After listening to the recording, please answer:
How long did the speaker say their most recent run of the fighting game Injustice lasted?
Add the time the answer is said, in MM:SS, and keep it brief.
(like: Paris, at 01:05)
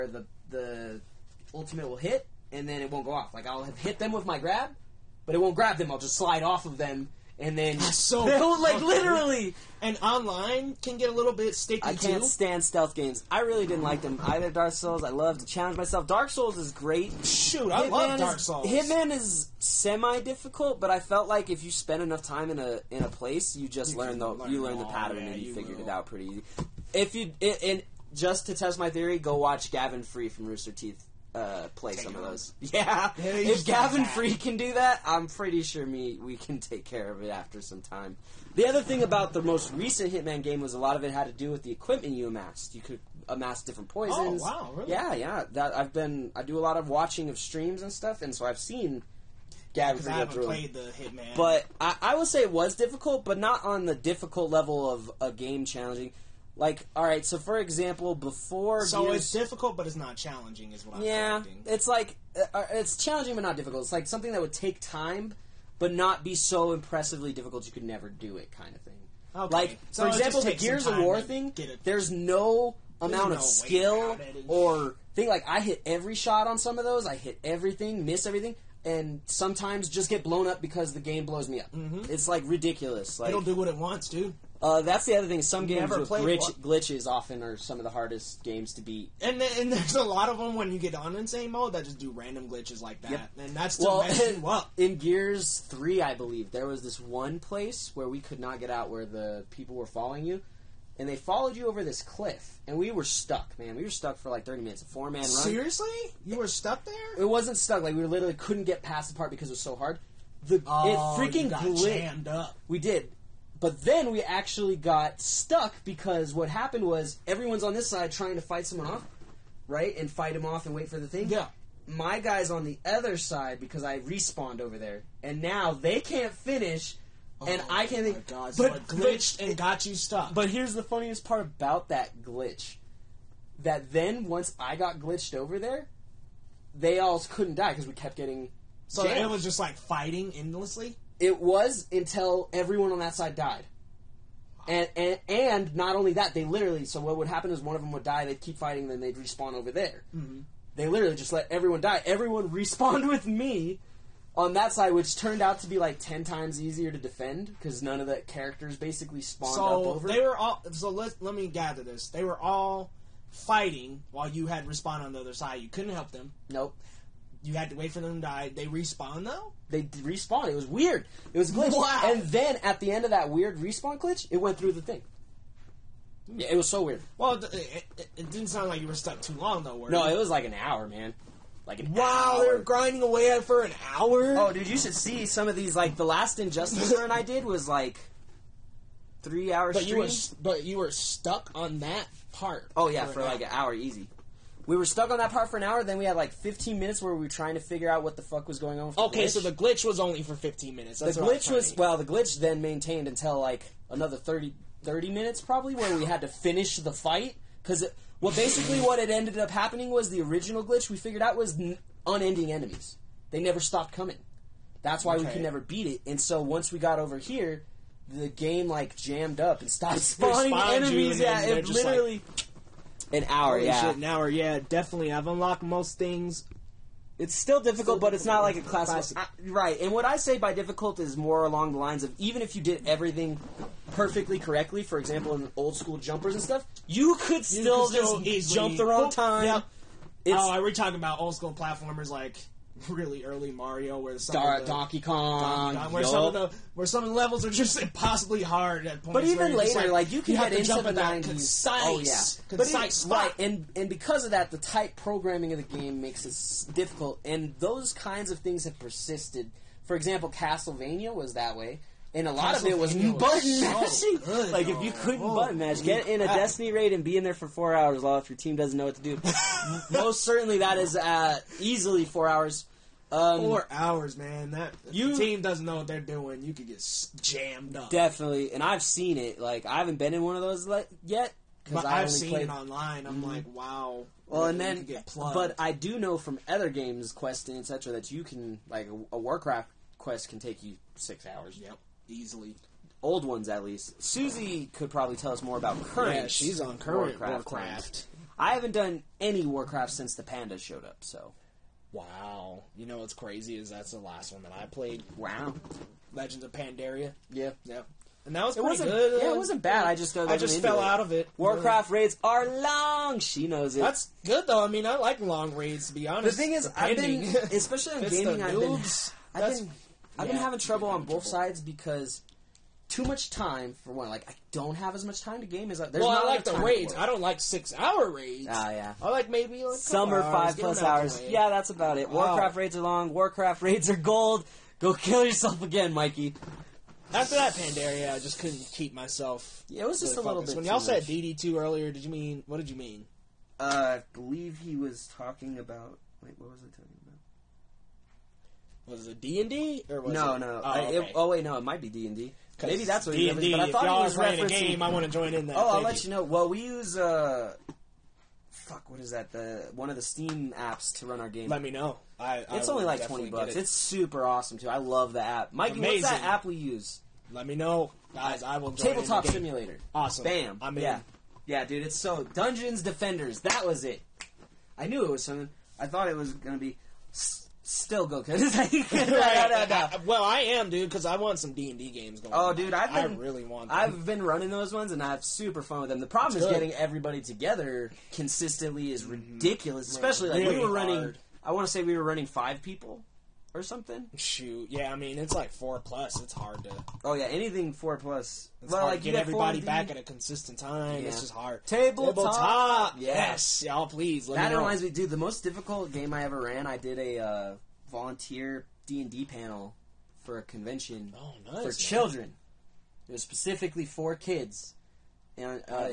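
three hours, at 03:09.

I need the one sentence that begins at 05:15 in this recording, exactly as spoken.
To be honest, the thing is, I've been especially on gaming.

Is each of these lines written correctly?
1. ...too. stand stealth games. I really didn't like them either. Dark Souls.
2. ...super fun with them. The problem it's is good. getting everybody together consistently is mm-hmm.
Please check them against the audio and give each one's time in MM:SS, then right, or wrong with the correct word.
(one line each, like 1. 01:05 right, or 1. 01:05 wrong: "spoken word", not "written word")
1. 00:12 right
2. 06:25 right.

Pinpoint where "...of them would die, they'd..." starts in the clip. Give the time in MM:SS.
02:27.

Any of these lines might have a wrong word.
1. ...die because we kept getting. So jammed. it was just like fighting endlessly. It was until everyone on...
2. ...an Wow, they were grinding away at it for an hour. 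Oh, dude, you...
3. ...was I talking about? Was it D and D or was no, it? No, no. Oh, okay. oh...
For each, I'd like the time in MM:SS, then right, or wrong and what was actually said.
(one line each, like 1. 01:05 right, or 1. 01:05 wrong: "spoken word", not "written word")
1. 02:17 right
2. 03:01 right
3. 05:46 right.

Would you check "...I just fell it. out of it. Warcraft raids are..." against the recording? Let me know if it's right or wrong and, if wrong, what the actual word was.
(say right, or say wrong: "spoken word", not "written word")
right.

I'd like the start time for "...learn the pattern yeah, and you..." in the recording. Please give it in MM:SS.
00:24.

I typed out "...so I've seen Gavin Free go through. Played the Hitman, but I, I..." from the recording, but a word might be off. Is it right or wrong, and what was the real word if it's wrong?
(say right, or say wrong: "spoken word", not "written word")
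right.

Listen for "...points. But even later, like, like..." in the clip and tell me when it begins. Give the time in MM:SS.
04:09.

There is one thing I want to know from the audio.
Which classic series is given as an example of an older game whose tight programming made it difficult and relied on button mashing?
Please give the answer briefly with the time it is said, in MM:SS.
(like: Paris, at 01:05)
Castlevania, at 04:20.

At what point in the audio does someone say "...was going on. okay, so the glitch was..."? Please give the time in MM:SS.
03:18.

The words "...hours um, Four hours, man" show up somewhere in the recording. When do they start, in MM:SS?
04:32.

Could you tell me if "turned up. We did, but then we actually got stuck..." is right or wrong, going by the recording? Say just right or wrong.
wrong.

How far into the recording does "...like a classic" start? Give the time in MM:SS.
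03:48.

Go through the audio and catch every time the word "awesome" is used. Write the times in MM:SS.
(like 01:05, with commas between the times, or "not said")
06:04, 06:09.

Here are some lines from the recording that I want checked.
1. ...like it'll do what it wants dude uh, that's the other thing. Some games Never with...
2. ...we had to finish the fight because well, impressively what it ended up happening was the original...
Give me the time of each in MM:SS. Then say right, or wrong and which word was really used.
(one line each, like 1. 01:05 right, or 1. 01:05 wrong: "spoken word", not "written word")
1. 01:23 right
2. 03:25 wrong: "basically", not "impressively".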